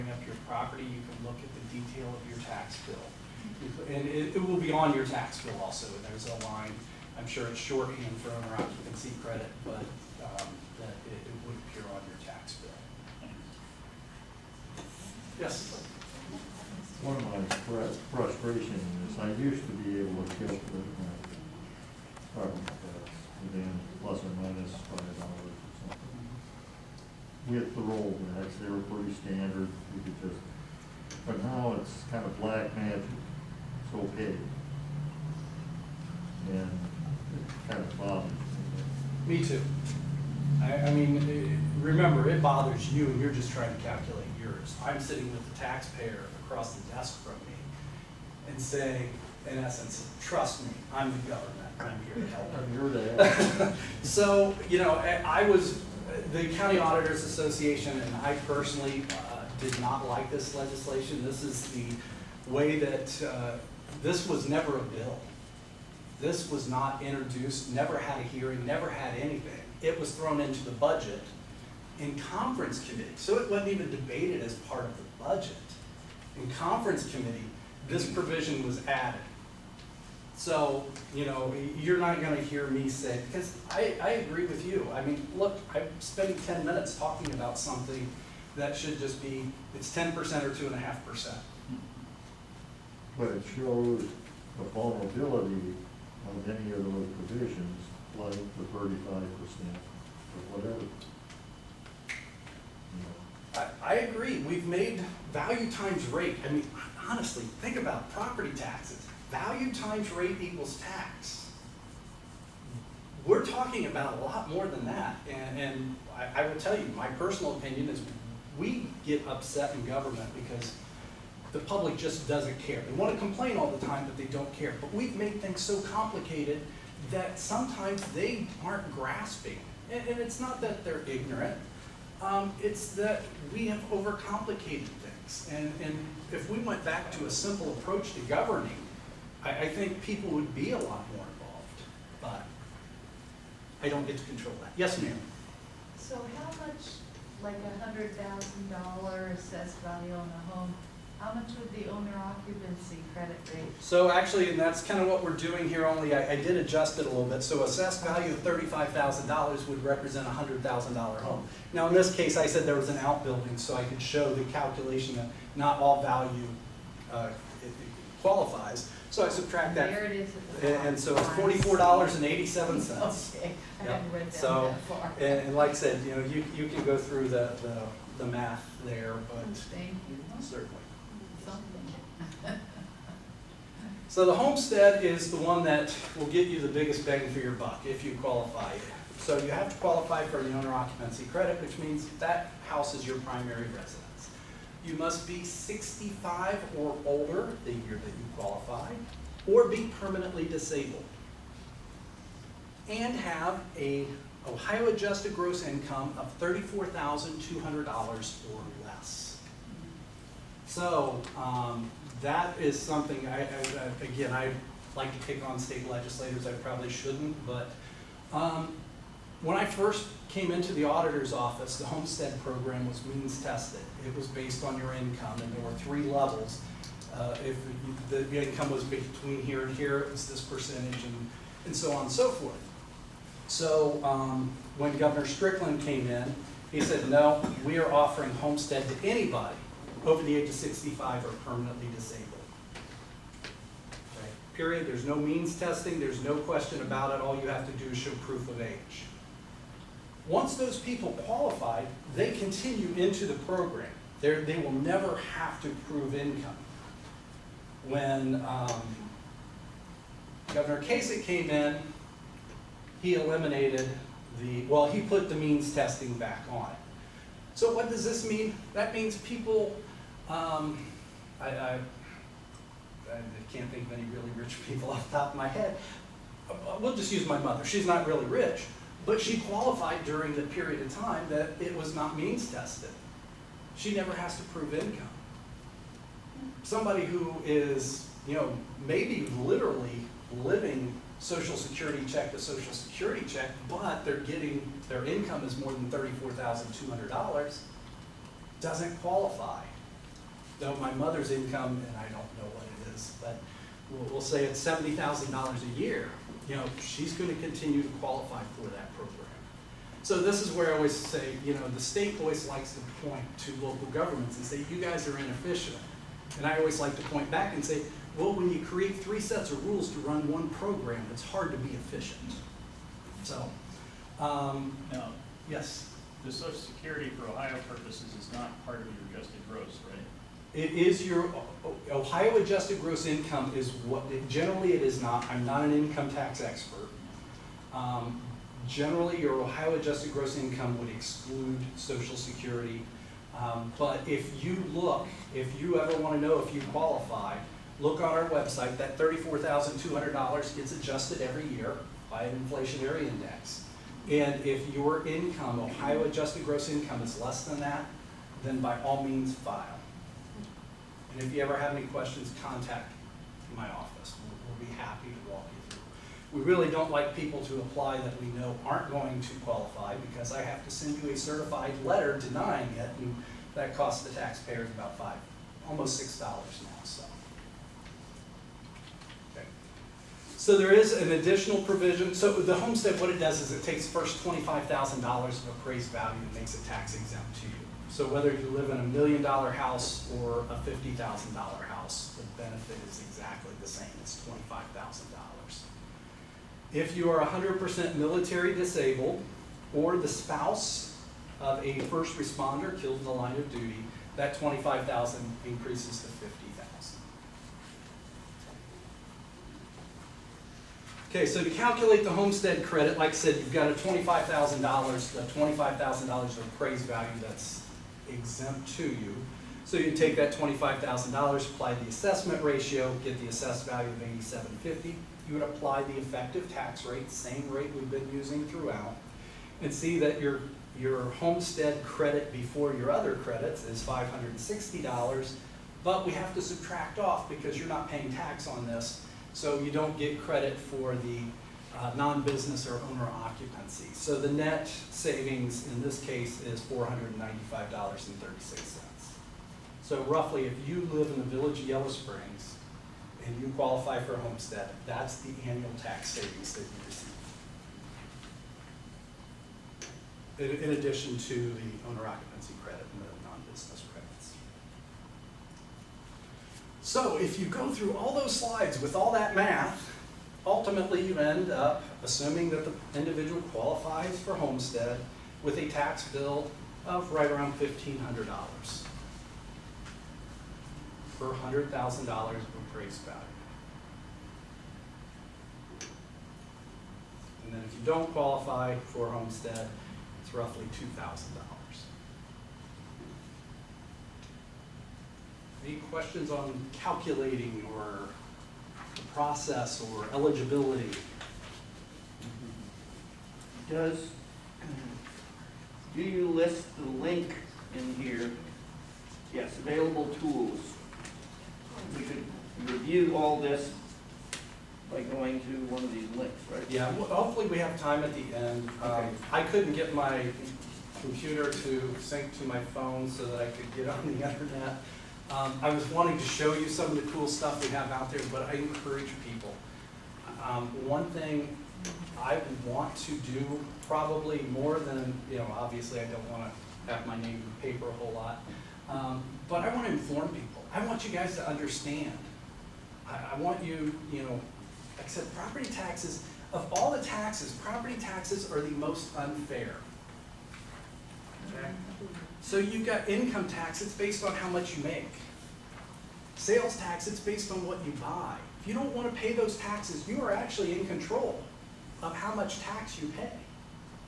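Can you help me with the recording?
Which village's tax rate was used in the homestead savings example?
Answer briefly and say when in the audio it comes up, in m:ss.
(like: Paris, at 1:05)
Yellow Springs, at 7:31.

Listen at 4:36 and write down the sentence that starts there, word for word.
Uh, uh, we'll just use my mother.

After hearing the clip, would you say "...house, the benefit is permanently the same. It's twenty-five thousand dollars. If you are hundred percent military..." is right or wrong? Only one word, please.
wrong.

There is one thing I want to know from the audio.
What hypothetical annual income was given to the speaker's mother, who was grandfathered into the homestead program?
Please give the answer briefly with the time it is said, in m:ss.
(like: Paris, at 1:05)
$70,000, at 5:04.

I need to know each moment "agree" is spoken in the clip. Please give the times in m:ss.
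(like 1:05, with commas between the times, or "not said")
1:24, 1:44.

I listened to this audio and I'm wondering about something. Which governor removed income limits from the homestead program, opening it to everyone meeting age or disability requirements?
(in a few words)
Governor Strickland.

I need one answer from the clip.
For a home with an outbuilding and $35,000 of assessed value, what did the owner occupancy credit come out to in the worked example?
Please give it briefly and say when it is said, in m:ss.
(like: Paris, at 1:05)
$44.87, at 2:51.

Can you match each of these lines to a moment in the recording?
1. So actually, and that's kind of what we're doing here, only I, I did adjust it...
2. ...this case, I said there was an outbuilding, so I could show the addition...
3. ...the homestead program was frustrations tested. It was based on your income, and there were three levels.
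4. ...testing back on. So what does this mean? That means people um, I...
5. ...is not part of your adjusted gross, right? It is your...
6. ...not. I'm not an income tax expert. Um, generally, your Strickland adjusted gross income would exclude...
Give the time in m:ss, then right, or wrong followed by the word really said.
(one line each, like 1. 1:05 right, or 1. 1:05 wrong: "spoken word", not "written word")
1. 2:33 right
2. 2:41 wrong: "calculation", not "addition"
3. 3:41 wrong: "means", not "frustrations"
4. 4:25 right
5. 5:28 right
6. 5:35 wrong: "Ohio", not "Strickland".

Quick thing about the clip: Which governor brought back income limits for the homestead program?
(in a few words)
Governor Kasich.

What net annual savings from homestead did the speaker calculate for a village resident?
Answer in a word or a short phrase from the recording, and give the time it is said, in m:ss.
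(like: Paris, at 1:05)
$495.36, at 7:26.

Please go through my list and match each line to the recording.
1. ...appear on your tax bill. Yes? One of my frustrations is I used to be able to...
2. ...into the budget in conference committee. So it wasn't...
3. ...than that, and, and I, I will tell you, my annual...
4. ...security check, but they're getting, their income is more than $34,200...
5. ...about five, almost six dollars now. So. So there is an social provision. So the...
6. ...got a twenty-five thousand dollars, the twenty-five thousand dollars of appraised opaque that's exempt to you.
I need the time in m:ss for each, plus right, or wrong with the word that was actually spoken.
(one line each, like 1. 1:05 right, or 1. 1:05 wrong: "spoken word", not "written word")
1. 0:11 right
2. 1:10 right
3. 1:54 wrong: "personal", not "annual"
4. 4:52 right
5. 6:14 wrong: "additional", not "social"
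6. 6:53 wrong: "value", not "opaque".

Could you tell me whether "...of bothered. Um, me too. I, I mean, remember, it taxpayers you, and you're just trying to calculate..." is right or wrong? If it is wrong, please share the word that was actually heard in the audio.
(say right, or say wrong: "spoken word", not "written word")
wrong: "bothers", not "taxpayers".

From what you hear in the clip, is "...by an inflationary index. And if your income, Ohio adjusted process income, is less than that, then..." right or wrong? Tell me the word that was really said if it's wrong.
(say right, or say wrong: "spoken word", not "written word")
wrong: "gross", not "process".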